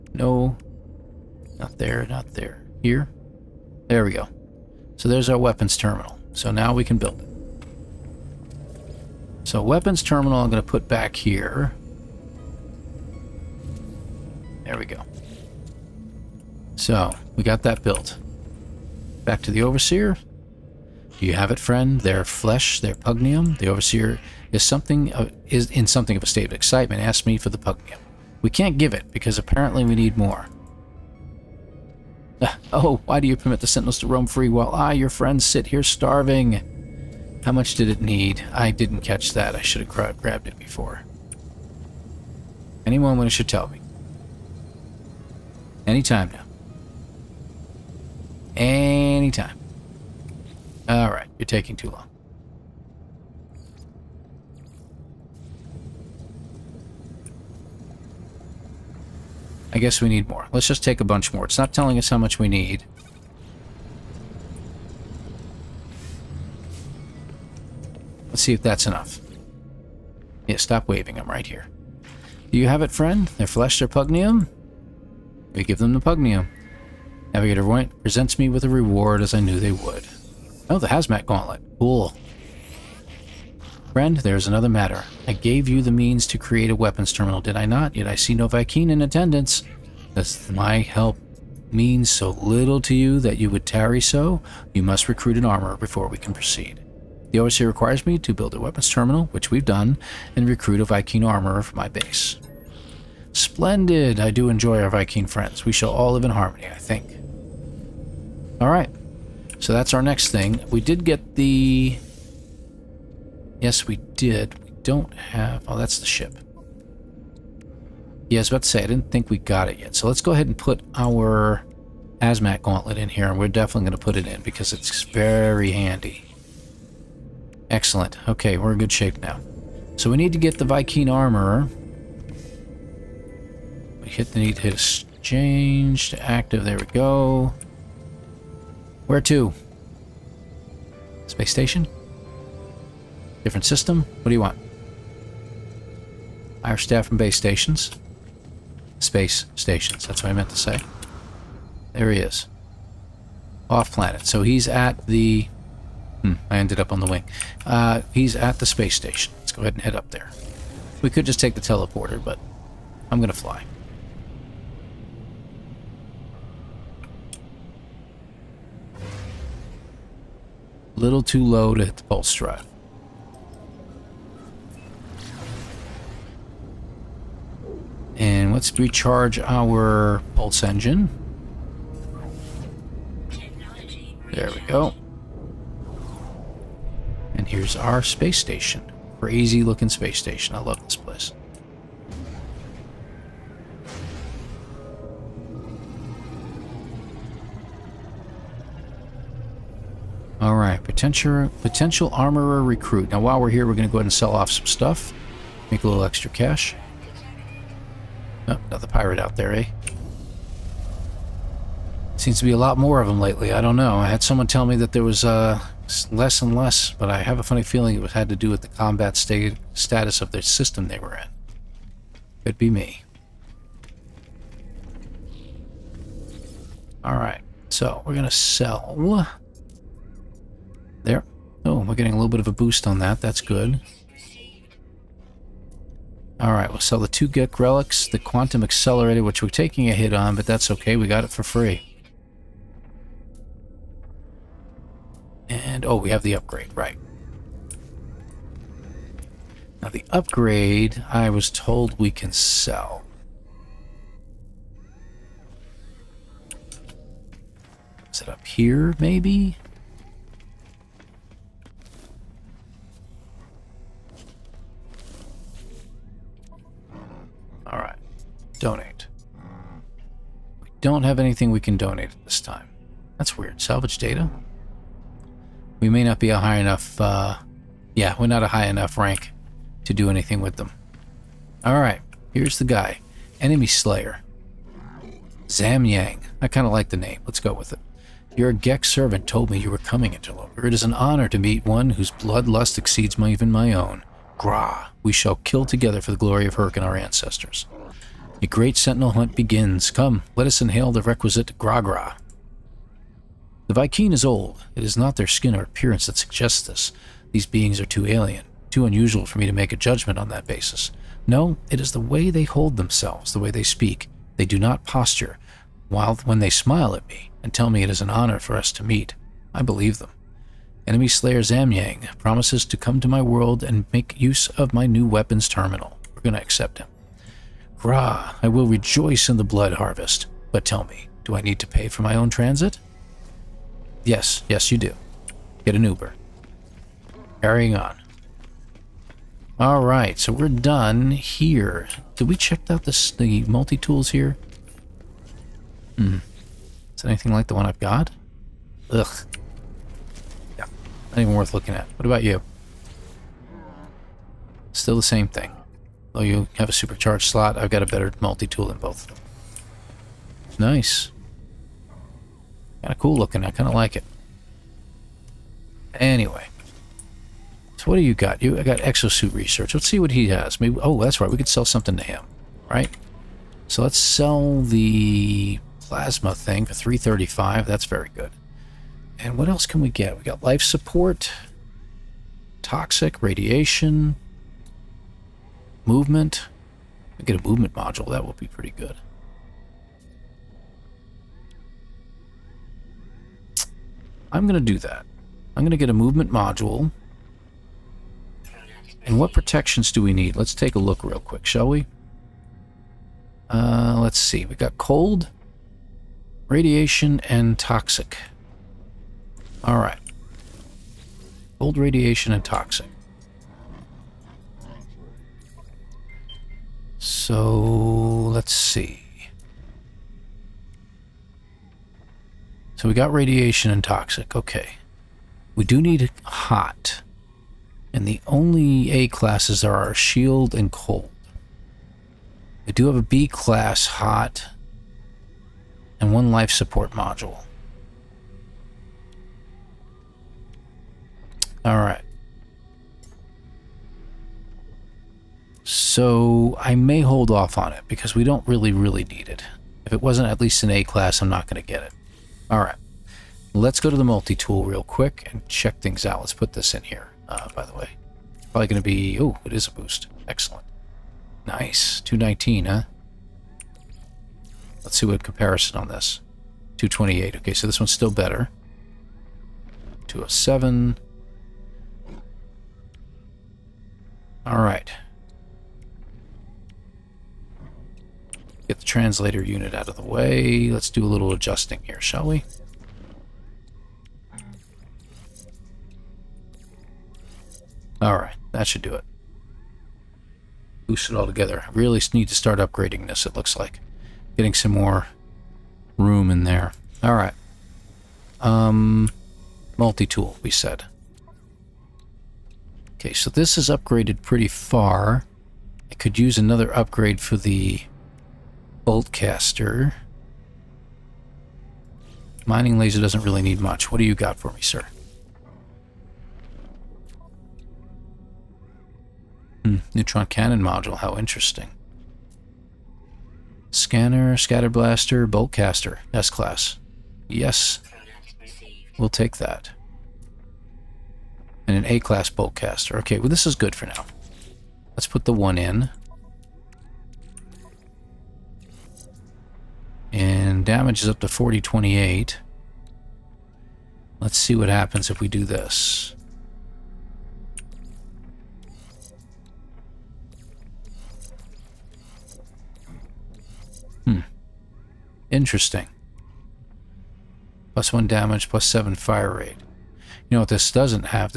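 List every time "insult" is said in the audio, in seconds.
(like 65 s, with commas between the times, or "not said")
not said.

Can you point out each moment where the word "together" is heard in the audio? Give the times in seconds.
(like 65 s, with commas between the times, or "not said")
295 s, 491 s.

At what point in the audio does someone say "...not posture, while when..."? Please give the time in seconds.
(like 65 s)
314 s.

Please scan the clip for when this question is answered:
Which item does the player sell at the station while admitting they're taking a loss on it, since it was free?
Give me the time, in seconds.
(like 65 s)
238 s.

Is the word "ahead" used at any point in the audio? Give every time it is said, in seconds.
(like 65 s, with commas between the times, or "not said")
120 s, 159 s, 203 s.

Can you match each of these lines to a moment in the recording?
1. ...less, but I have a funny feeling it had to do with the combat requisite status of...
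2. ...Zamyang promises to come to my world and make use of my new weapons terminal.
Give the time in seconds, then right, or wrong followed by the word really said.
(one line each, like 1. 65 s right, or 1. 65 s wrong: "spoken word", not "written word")
1. 216 s wrong: "state", not "requisite"
2. 321 s right.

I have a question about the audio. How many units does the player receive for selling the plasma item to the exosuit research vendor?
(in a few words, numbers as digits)
335.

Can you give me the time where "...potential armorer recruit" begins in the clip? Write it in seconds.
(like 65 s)
201 s.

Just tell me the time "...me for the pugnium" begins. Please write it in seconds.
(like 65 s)
27 s.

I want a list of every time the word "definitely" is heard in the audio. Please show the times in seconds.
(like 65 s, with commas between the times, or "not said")
123 s.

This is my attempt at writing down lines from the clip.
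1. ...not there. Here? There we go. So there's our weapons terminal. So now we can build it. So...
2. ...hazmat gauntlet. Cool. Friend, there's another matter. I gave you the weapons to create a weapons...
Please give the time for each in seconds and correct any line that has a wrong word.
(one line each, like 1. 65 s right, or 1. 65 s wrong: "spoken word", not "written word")
1. 2 s right
2. 80 s wrong: "means", not "weapons".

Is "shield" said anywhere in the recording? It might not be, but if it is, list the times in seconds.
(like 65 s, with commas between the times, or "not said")
429 s.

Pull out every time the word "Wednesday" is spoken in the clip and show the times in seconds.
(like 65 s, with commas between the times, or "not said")
not said.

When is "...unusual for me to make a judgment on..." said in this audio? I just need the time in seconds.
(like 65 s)
308 s.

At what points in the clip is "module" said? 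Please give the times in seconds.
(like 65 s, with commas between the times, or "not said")
387 s, 396 s, 436 s, 520 s.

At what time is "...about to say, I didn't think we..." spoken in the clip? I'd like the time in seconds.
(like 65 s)
118 s.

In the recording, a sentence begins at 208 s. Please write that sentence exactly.
Oh, another pirate out there, eh?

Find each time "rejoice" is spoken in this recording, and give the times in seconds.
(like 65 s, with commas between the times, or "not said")
328 s.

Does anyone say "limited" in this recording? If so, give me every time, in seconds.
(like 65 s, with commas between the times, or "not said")
not said.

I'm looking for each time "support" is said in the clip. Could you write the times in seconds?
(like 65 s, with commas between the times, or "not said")
380 s, 436 s.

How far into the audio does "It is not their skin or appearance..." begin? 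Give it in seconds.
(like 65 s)
304 s.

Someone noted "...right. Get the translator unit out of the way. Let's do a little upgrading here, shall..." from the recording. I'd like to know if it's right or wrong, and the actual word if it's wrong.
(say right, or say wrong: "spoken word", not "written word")
wrong: "adjusting", not "upgrading".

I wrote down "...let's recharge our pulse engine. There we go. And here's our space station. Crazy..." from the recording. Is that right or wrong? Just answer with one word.
right.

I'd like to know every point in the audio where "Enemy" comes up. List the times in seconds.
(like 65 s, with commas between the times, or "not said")
283 s, 320 s.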